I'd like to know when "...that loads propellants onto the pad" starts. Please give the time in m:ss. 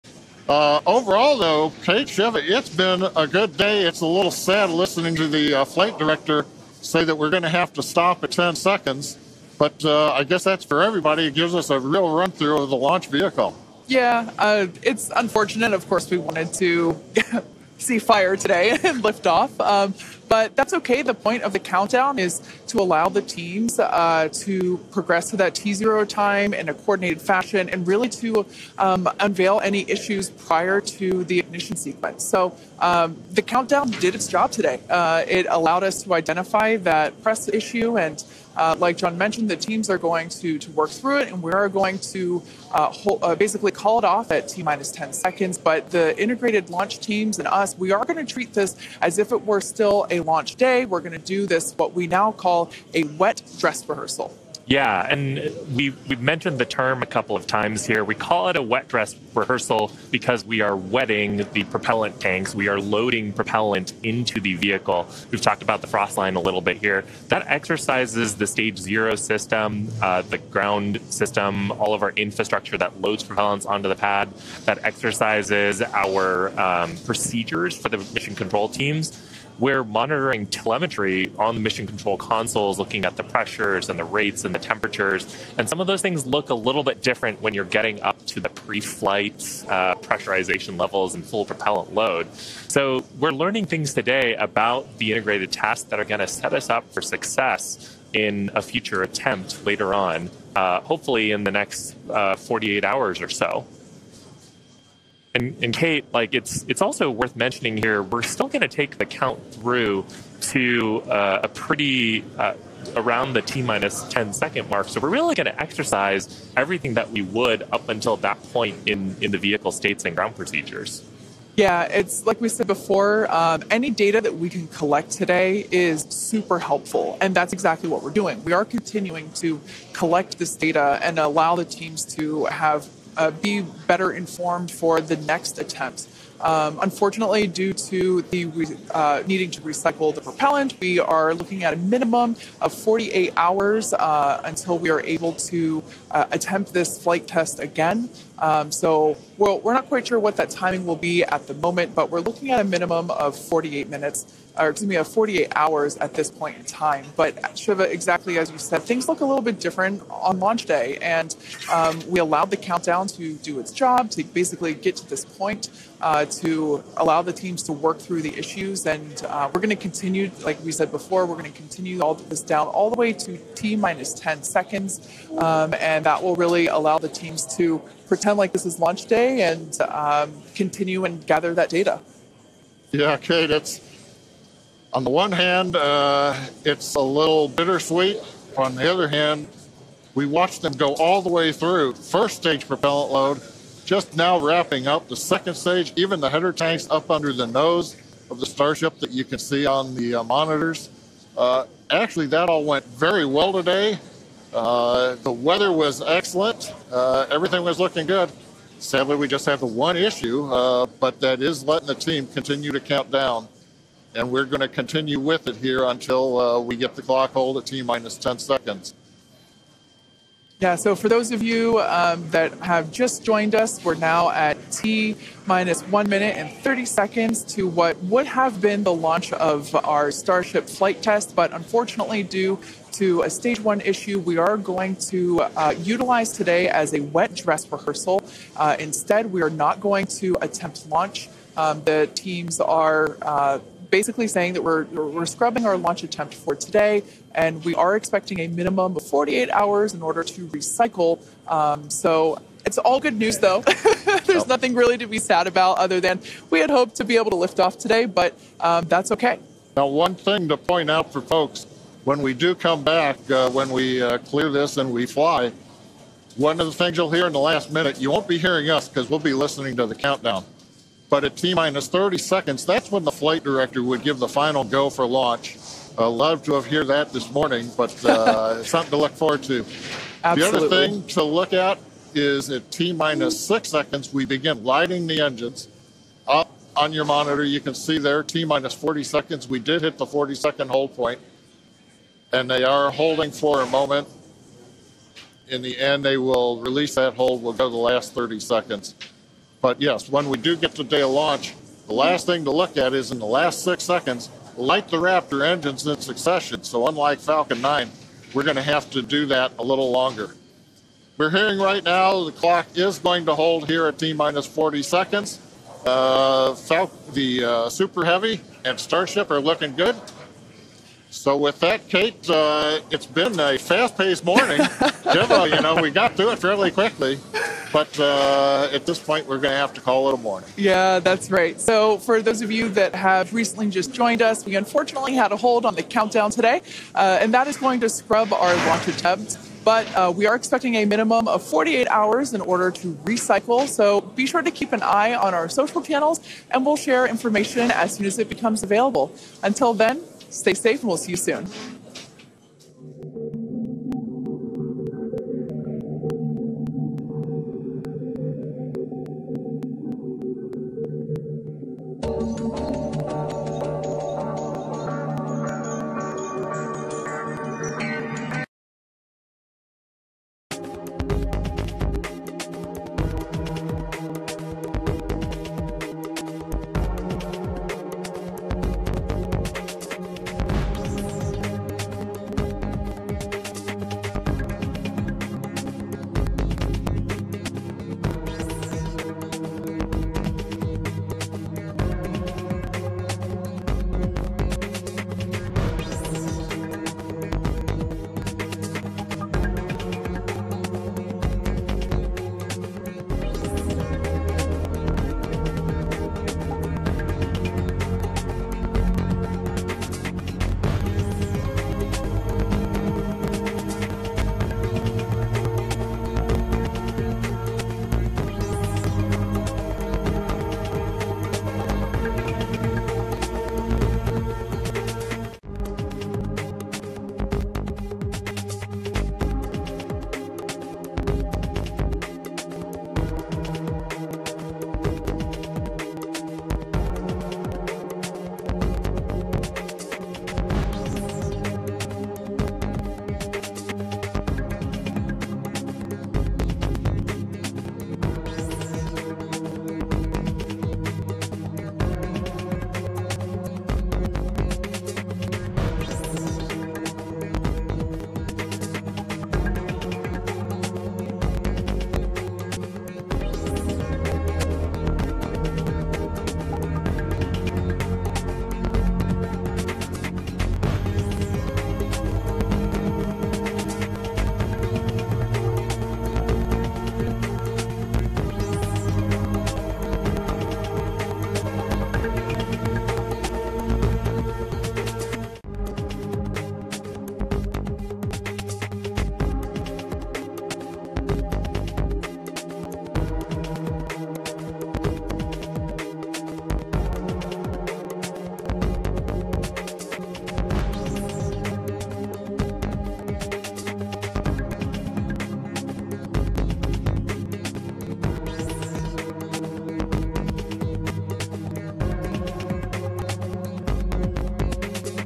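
1:12.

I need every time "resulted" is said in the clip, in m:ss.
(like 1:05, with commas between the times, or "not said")
not said.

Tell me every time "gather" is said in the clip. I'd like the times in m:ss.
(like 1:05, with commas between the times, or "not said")
3:01.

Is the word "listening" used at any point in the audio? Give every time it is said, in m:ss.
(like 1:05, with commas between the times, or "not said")
0:04, 4:29.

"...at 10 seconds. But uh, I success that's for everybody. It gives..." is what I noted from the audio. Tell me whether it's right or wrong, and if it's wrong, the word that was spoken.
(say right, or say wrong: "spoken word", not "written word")
wrong: "guess", not "success".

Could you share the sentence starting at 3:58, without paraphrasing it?
Uh, instead, we are not going to attempt launch.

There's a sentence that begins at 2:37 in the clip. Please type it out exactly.
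But Siva, exactly as you said, things look a little bit different on launch day.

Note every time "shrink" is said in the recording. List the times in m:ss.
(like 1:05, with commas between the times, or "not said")
not said.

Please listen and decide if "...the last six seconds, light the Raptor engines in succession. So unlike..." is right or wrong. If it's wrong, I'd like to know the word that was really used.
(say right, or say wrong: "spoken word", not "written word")
right.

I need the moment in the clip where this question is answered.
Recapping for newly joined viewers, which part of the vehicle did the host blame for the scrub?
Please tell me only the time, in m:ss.
3:53.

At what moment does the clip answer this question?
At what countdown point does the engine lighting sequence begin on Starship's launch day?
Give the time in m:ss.
4:42.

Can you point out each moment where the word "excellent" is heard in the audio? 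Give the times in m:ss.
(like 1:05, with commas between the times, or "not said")
3:26.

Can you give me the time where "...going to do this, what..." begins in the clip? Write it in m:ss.
0:50.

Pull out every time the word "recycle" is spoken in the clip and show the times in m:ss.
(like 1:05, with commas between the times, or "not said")
2:19, 4:10, 5:43.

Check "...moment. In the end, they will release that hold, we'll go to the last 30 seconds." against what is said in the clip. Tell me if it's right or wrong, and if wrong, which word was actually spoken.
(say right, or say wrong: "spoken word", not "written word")
right.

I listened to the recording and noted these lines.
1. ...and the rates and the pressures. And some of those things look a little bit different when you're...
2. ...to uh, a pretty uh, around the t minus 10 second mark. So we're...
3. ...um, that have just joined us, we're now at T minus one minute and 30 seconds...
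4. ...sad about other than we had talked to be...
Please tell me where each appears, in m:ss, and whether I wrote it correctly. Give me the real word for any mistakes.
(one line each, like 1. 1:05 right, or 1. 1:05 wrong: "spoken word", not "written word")
1. 1:23 wrong: "temperatures", not "pressures"
2. 1:50 right
3. 3:41 right
4. 4:15 wrong: "hoped", not "talked".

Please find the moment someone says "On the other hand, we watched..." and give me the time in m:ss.
3:08.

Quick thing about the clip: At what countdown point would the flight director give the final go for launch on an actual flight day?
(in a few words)
T minus 30 seconds.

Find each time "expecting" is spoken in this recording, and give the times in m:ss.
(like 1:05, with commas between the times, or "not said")
4:07, 5:40.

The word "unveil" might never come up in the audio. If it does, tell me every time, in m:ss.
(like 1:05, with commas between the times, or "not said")
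0:29.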